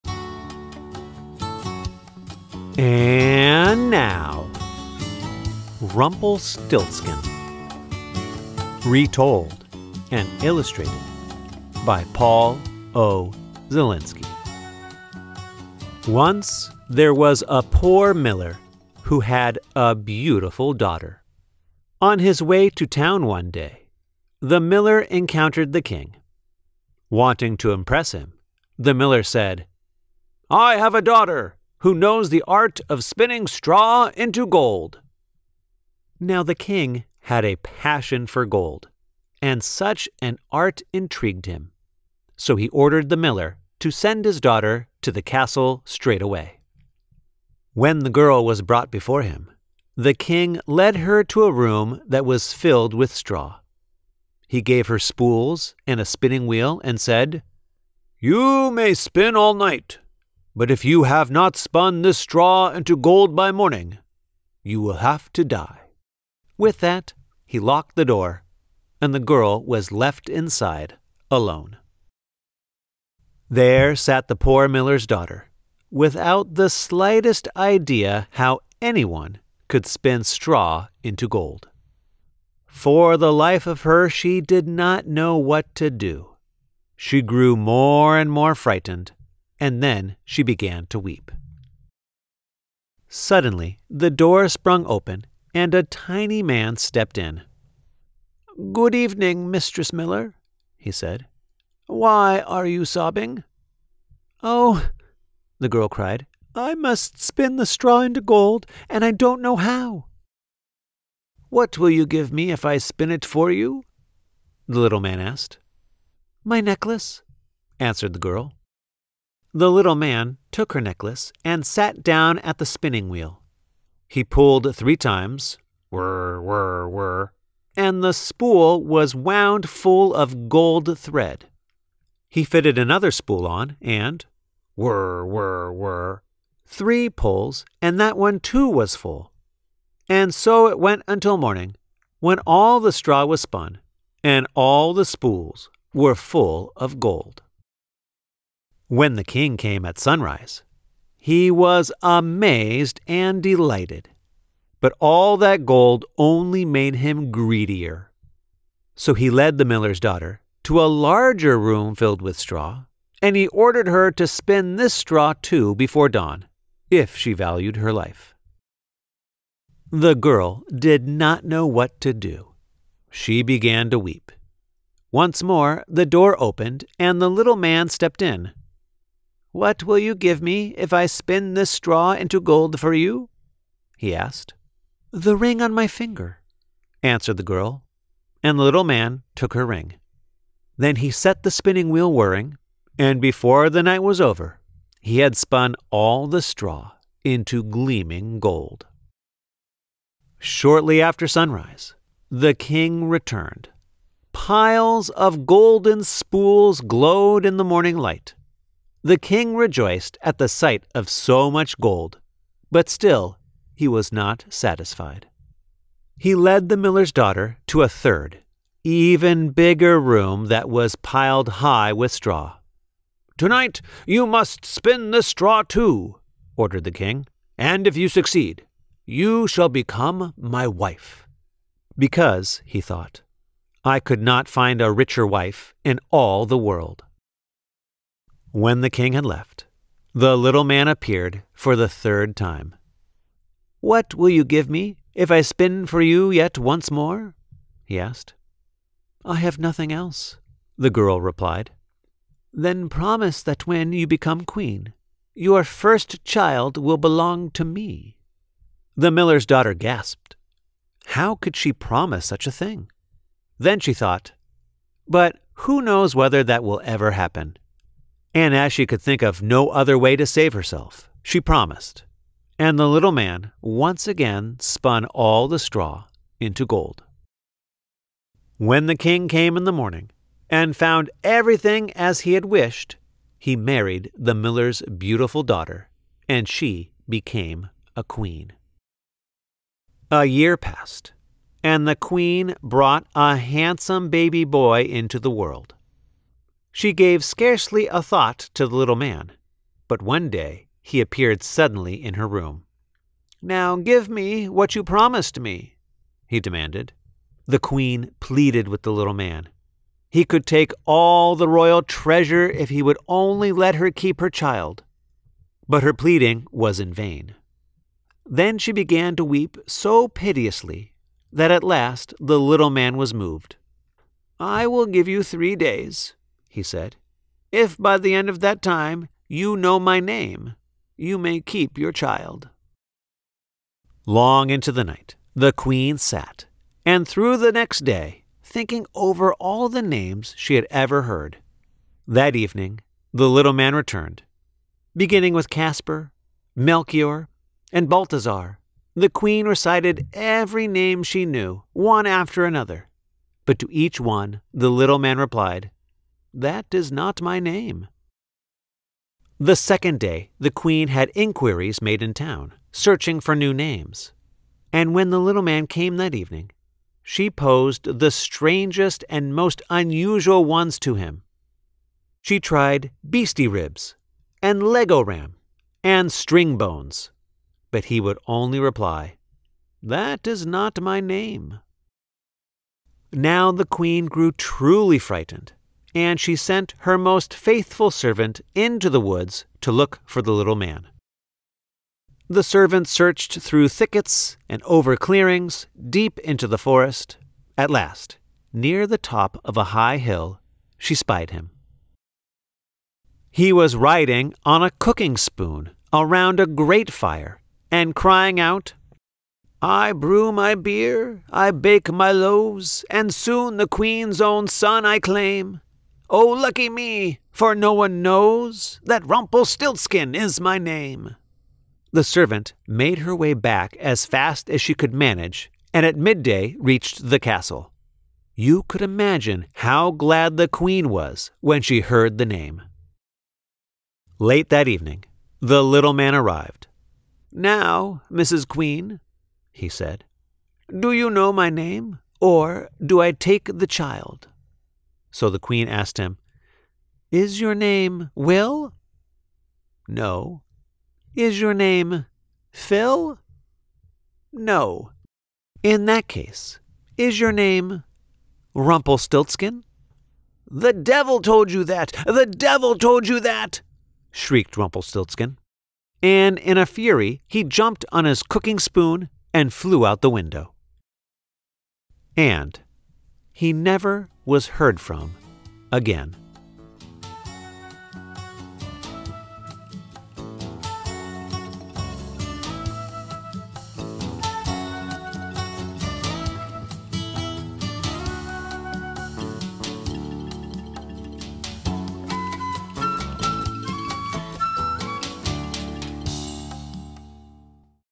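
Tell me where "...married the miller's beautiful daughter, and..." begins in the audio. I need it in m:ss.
4:43.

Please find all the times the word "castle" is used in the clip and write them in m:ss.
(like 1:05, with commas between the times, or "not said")
0:45, 7:07.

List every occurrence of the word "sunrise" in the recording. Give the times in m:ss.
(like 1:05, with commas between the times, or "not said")
2:29, 3:21.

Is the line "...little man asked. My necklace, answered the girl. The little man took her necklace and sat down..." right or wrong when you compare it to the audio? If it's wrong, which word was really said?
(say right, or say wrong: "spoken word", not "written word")
right.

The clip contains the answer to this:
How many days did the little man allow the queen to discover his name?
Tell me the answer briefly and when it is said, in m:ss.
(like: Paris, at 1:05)
3, at 5:25.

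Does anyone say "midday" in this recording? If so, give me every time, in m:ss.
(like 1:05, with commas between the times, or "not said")
7:05.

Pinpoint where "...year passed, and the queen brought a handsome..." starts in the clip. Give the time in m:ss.
4:50.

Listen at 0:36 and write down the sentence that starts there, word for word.
Now the king had a passion for gold, and such an art intrigued him.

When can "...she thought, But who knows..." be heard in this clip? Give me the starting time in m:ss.
4:23.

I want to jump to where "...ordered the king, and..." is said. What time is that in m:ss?
3:46.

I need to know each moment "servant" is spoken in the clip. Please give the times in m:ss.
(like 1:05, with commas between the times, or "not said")
6:27, 6:32, 7:02.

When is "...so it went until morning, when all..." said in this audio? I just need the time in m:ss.
2:20.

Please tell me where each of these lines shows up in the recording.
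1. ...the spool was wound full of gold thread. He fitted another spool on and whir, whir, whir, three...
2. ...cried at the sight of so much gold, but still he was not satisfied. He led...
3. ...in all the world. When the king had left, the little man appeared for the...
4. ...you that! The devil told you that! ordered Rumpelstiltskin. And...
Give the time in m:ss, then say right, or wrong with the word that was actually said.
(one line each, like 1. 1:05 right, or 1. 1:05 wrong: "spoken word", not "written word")
1. 2:08 right
2. 3:29 wrong: "rejoiced", not "cried"
3. 3:55 right
4. 7:41 wrong: "shrieked", not "ordered".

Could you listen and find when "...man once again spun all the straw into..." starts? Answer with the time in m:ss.
4:33.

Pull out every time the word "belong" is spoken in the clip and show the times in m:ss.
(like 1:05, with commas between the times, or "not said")
4:16.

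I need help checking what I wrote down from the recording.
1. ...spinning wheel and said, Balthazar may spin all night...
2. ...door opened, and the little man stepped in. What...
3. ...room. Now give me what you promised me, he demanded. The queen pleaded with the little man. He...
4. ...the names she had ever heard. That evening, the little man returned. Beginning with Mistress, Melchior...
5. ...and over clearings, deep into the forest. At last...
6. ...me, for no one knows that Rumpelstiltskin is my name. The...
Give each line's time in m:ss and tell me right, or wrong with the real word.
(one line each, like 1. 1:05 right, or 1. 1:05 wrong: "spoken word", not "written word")
1. 0:56 wrong: "You", not "Balthazar"
2. 2:56 right
3. 5:02 right
4. 5:39 wrong: "Caspar", not "Mistress"
5. 6:34 right
6. 6:56 right.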